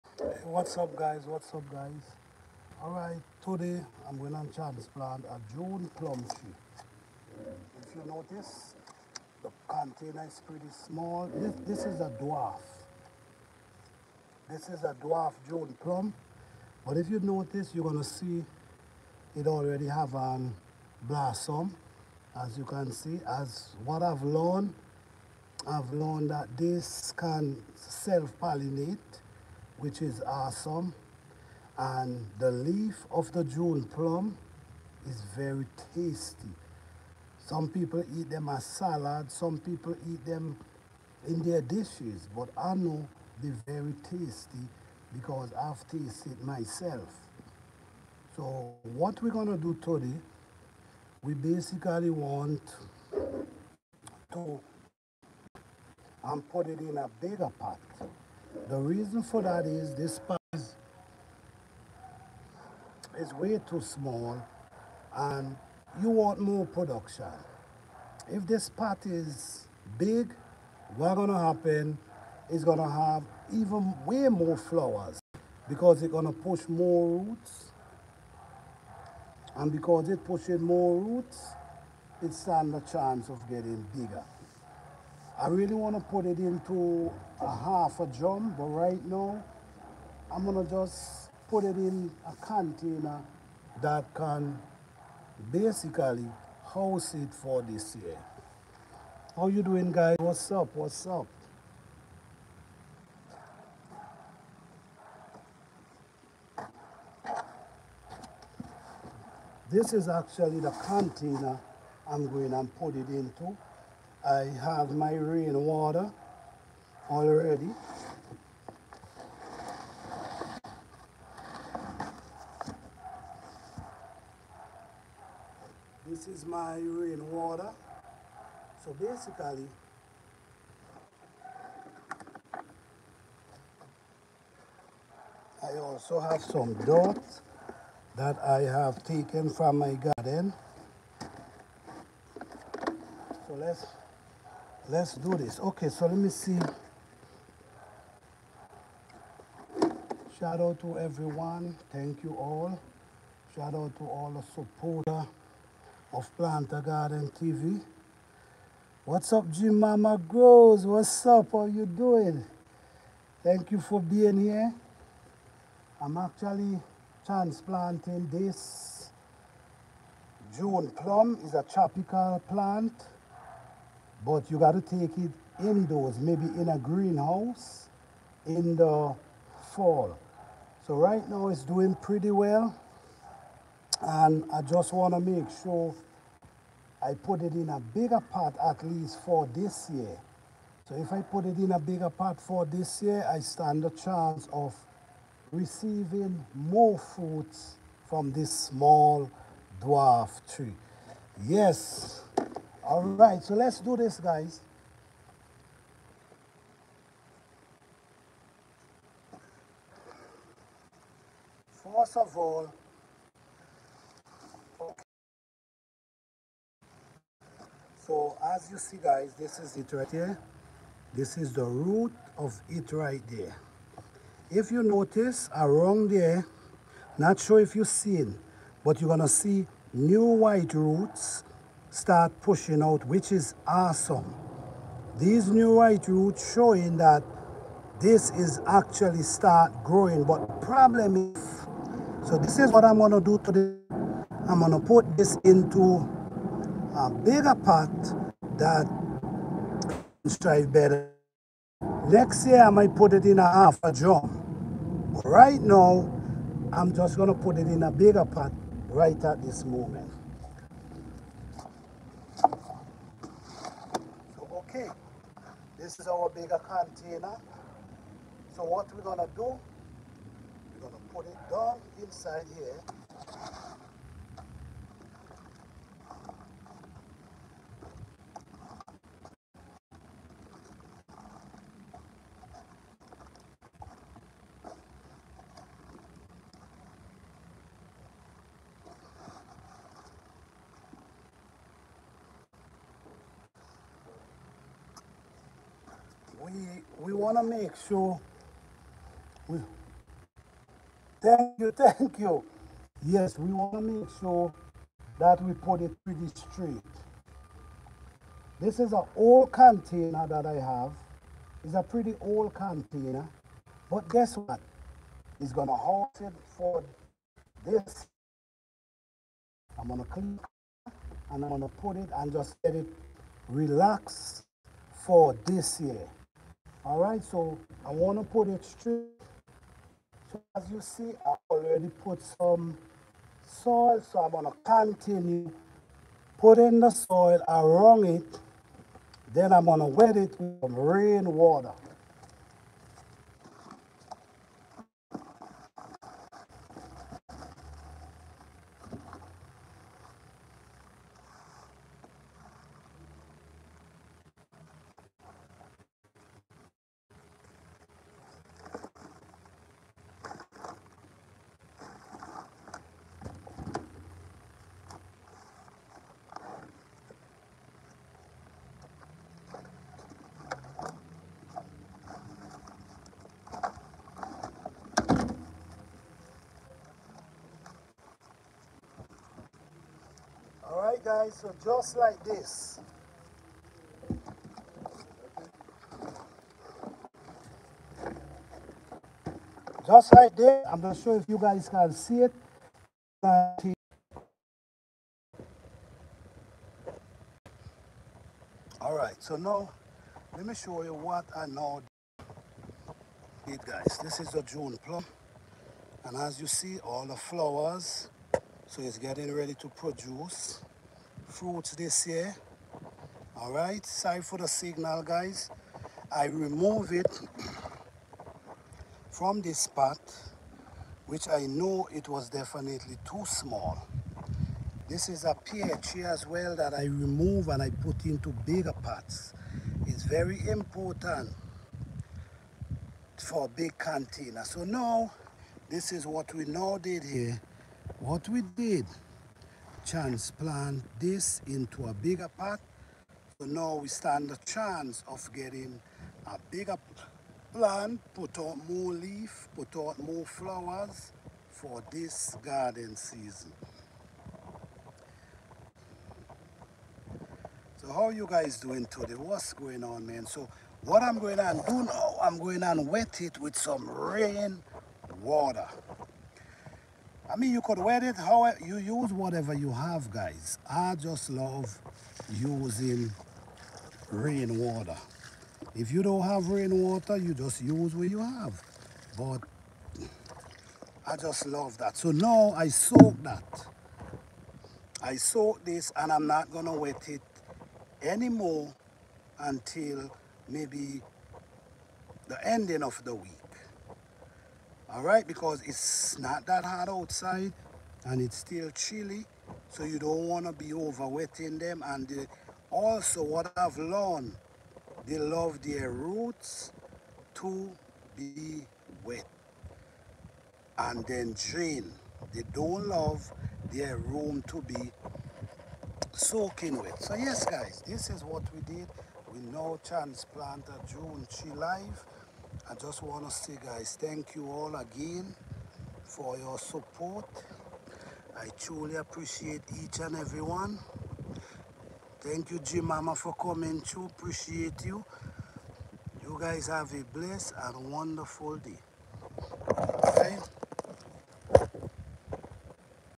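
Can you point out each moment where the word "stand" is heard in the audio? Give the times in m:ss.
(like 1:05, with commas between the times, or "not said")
1:22, 3:13, 7:23.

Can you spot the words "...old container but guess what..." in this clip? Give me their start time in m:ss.
5:12.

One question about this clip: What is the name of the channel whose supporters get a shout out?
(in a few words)
Planter Garden TV.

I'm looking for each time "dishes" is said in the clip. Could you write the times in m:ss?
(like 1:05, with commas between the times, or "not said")
0:41.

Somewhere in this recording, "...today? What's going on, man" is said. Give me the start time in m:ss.
7:38.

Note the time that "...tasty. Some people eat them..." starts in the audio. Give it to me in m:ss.
0:35.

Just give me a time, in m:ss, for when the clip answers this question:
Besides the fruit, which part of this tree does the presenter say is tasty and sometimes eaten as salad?
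0:32.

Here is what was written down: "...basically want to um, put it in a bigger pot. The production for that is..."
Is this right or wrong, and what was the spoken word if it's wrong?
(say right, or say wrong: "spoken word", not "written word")
wrong: "reason", not "production".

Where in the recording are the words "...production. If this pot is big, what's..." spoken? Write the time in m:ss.
1:06.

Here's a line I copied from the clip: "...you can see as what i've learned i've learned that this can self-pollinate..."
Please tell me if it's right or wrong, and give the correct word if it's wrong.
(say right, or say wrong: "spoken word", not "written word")
right.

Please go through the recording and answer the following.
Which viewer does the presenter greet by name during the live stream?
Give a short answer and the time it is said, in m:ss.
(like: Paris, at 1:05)
G Mama Grows, at 2:39.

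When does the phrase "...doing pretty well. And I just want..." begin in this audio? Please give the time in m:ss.
3:01.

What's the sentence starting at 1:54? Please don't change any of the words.
I have my rain water already.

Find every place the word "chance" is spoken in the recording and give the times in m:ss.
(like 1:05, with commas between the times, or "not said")
1:22, 3:13, 7:24.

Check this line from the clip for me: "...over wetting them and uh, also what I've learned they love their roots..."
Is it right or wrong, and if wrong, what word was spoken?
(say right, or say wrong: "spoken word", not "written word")
right.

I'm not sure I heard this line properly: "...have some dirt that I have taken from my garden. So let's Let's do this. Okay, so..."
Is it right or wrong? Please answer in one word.
right.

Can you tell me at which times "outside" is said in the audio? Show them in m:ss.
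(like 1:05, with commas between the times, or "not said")
8:16.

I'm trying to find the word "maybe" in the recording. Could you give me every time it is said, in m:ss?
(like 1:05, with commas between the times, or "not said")
2:56, 8:10.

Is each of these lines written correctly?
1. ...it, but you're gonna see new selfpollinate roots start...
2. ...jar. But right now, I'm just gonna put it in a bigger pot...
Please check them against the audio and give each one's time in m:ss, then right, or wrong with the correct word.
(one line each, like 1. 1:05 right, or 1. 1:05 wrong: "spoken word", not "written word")
1. 3:48 wrong: "white", not "selfpollinate"
2. 4:13 right.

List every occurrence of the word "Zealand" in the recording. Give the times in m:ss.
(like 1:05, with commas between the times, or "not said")
not said.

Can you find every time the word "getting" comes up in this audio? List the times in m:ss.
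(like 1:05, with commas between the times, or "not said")
1:23, 6:48, 7:25.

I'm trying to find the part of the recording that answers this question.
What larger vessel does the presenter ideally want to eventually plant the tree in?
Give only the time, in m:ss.
1:27.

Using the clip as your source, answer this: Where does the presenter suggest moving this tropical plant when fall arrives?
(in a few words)
A greenhouse.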